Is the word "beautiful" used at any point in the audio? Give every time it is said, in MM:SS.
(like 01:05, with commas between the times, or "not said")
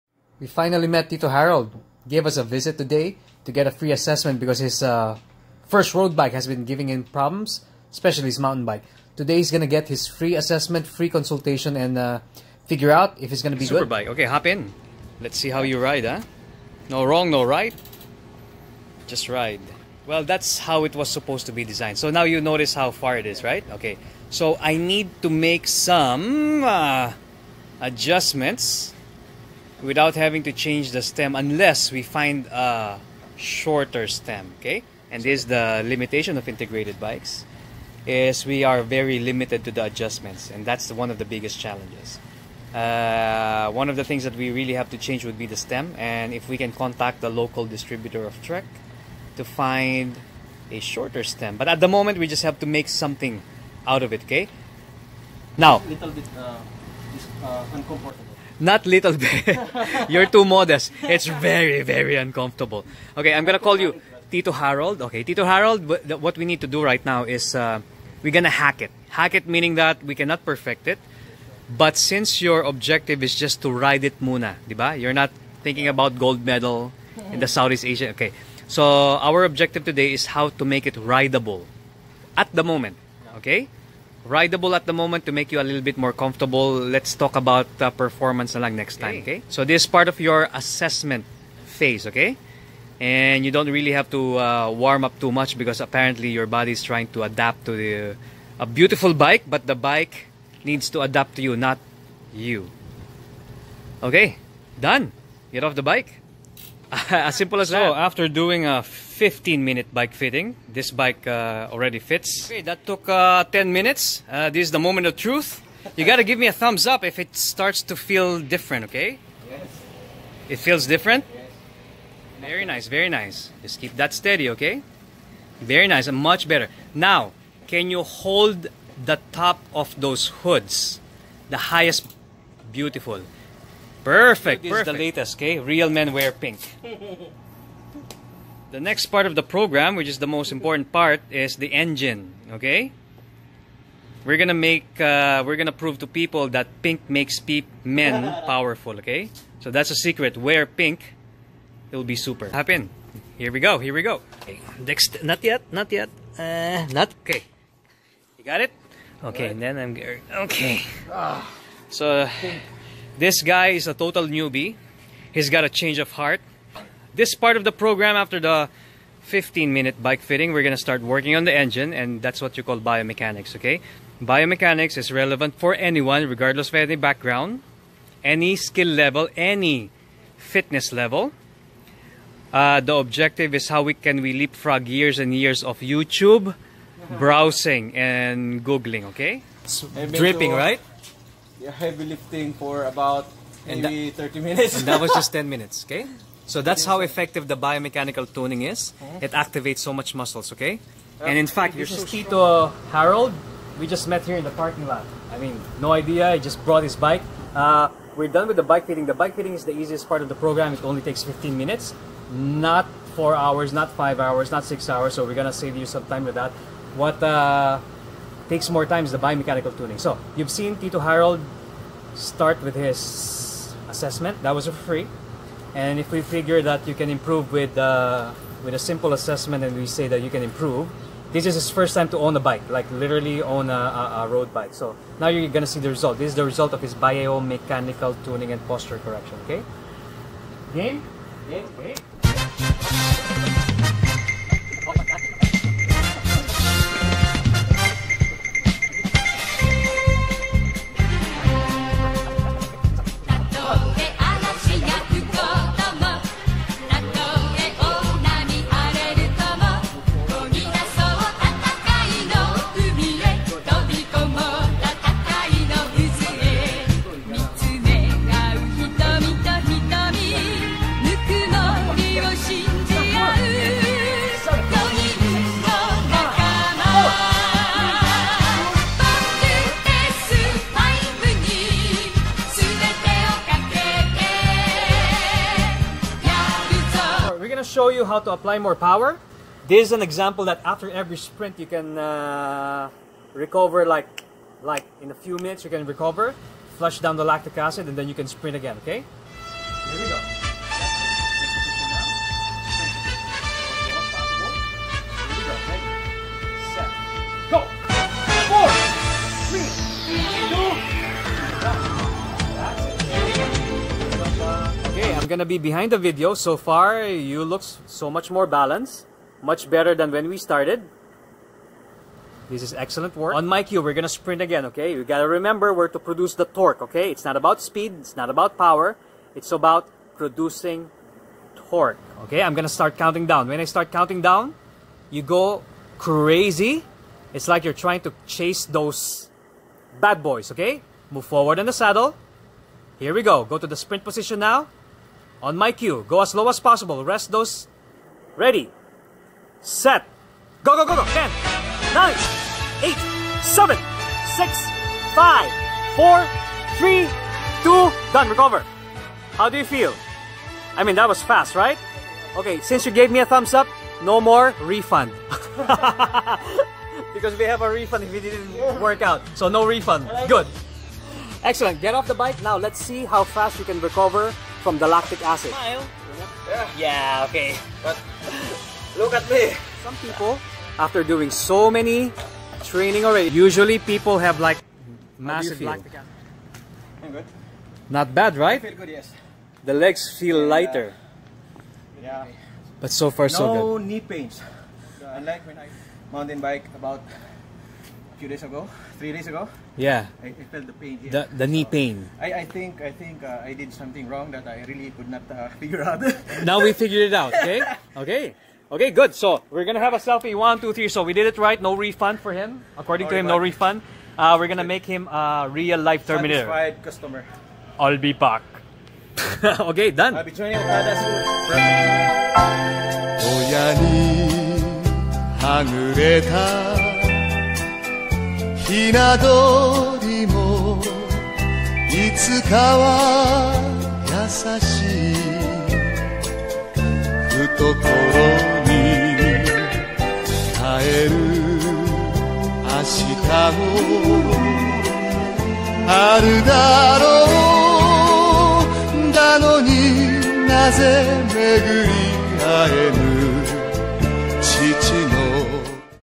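01:38, 02:12.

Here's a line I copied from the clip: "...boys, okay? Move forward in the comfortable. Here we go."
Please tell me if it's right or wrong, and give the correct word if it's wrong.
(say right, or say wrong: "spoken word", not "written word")
wrong: "saddle", not "comfortable".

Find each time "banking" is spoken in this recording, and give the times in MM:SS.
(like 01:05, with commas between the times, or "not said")
not said.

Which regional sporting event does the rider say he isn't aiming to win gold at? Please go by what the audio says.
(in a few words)
Southeast Asia.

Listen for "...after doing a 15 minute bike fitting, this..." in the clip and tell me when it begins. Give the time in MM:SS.
01:47.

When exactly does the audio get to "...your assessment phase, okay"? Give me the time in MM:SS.
01:30.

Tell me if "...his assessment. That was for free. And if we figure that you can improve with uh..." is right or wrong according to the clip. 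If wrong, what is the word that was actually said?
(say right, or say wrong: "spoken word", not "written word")
right.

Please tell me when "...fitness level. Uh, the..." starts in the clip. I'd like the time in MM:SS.
03:00.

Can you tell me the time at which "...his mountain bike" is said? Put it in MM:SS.
00:08.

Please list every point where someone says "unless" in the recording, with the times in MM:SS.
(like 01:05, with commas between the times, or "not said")
00:31.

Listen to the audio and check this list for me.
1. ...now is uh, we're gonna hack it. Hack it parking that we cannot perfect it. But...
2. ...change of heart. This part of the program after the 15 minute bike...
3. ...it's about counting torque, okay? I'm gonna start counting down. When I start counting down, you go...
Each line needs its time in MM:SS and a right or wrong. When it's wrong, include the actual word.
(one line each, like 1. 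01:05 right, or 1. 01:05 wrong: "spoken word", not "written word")
1. 01:07 wrong: "meaning", not "parking"
2. 02:45 right
3. 05:29 wrong: "producing", not "counting".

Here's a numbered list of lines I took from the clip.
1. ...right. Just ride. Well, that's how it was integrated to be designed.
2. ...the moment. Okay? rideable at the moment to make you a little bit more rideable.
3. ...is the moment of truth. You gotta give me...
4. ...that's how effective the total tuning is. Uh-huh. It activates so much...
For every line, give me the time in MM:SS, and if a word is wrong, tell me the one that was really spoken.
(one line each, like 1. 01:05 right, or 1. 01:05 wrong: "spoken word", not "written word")
1. 00:17 wrong: "supposed", not "integrated"
2. 01:22 wrong: "comfortable", not "rideable"
3. 01:54 right
4. 03:16 wrong: "biomechanical", not "total".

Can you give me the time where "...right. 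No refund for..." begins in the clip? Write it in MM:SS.
06:51.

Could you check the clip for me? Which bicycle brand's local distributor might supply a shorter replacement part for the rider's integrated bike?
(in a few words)
Trek.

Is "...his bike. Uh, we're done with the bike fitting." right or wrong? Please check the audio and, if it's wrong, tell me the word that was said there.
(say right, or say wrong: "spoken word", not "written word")
right.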